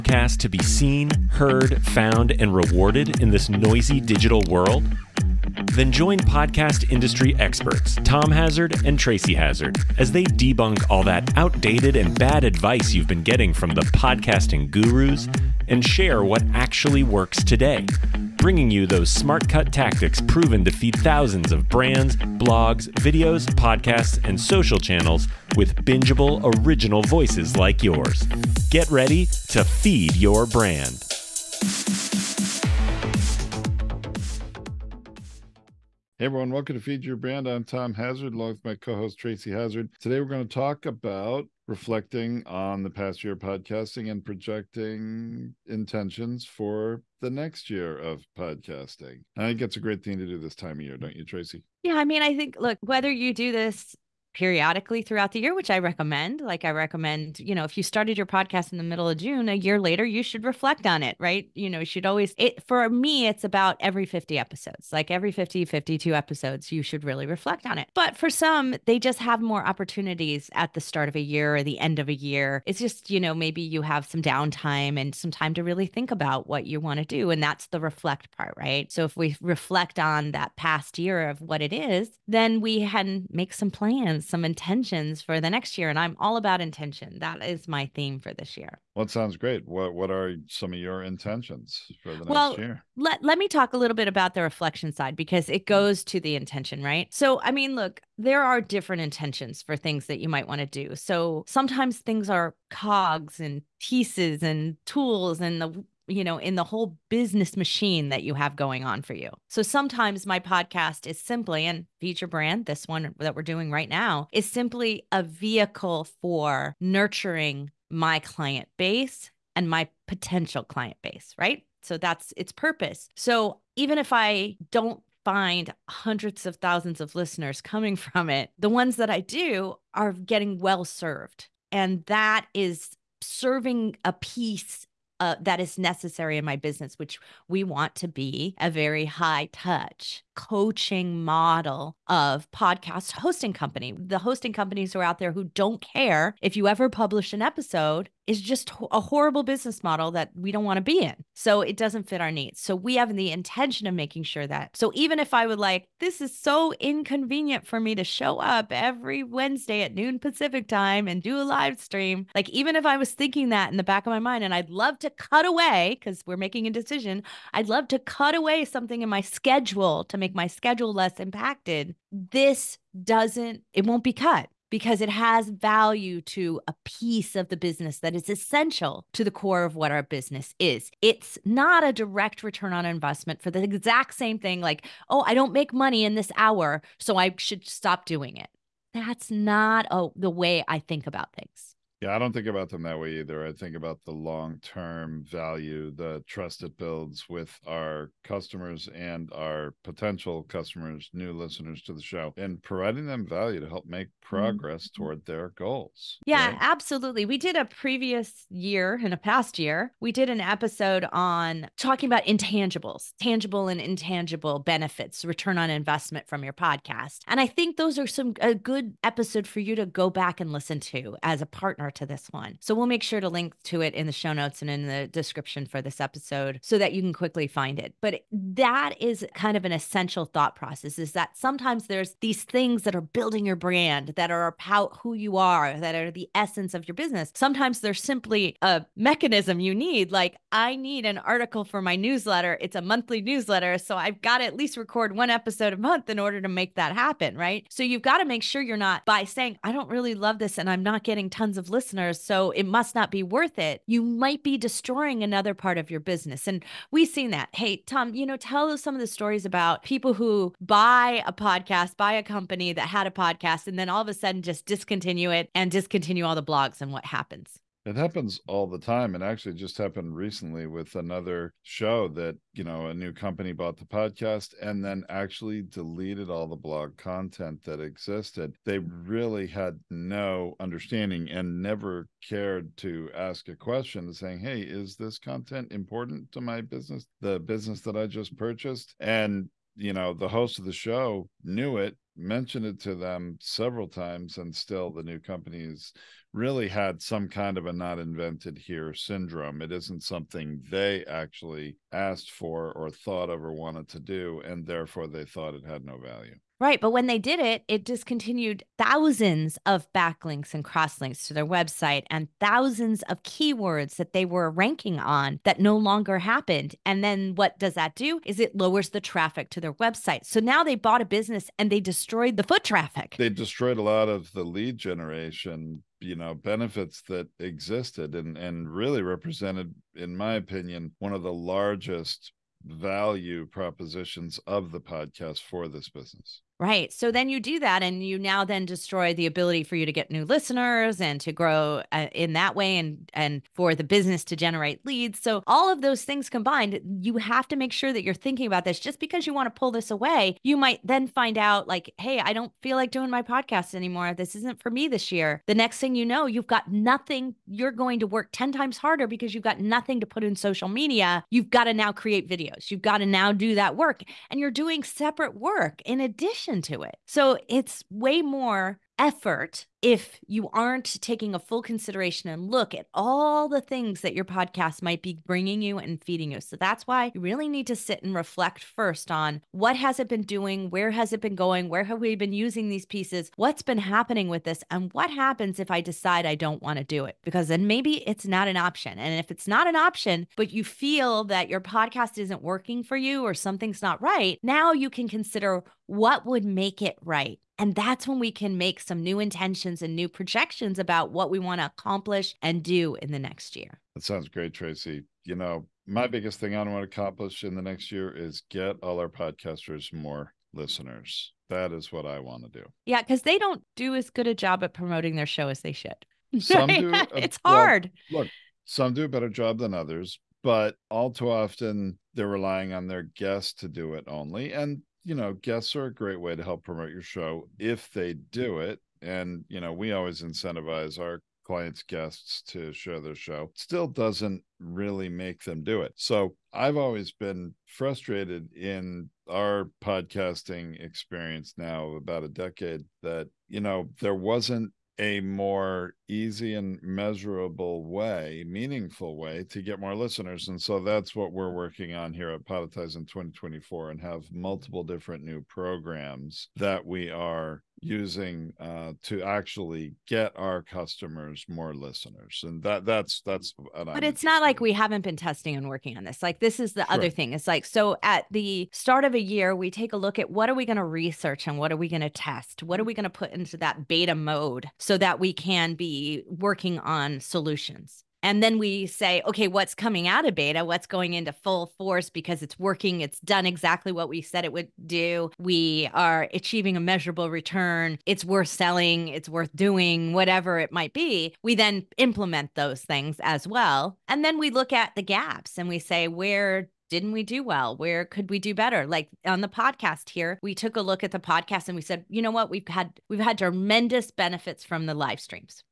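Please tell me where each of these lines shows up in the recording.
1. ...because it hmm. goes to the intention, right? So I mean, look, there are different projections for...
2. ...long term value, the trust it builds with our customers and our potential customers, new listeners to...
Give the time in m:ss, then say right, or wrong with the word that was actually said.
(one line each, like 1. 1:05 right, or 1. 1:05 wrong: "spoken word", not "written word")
1. 1:35 wrong: "intentions", not "projections"
2. 3:14 right.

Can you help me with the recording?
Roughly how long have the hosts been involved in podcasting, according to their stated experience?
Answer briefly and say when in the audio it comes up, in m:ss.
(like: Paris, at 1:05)
About a decade, at 7:21.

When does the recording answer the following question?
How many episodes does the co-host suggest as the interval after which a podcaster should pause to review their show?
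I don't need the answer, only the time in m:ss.
1:03.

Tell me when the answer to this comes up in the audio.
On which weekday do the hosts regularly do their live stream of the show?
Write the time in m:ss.
2:39.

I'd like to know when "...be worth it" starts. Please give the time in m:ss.
4:13.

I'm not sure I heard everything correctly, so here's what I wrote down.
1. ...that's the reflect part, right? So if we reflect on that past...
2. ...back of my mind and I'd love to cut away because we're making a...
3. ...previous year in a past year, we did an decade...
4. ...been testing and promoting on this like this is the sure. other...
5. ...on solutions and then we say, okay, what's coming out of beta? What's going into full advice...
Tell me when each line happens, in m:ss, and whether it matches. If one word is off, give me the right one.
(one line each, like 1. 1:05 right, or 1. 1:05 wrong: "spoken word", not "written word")
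1. 1:17 right
2. 2:43 right
3. 3:27 wrong: "episode", not "decade"
4. 7:45 wrong: "working", not "promoting"
5. 7:56 wrong: "force", not "advice".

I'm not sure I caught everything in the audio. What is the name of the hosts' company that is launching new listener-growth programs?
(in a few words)
Podetize.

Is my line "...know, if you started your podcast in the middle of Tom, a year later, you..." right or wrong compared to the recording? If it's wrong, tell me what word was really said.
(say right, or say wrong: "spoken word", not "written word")
wrong: "June", not "Tom".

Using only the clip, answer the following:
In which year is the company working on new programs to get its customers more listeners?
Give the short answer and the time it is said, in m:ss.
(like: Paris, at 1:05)
2024, at 7:33.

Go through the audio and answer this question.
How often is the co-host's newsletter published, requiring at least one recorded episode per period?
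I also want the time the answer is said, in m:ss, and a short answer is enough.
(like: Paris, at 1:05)
Monthly, at 4:02.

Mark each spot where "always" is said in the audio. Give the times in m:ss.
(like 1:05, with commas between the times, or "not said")
1:02, 7:09, 7:16.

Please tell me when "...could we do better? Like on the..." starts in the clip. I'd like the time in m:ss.
8:18.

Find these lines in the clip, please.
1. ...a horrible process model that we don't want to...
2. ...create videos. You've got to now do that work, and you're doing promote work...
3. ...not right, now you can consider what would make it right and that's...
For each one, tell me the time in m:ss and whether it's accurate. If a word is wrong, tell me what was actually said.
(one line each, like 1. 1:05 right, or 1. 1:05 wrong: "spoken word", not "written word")
1. 2:28 wrong: "business", not "process"
2. 6:01 wrong: "separate", not "promote"
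3. 6:33 right.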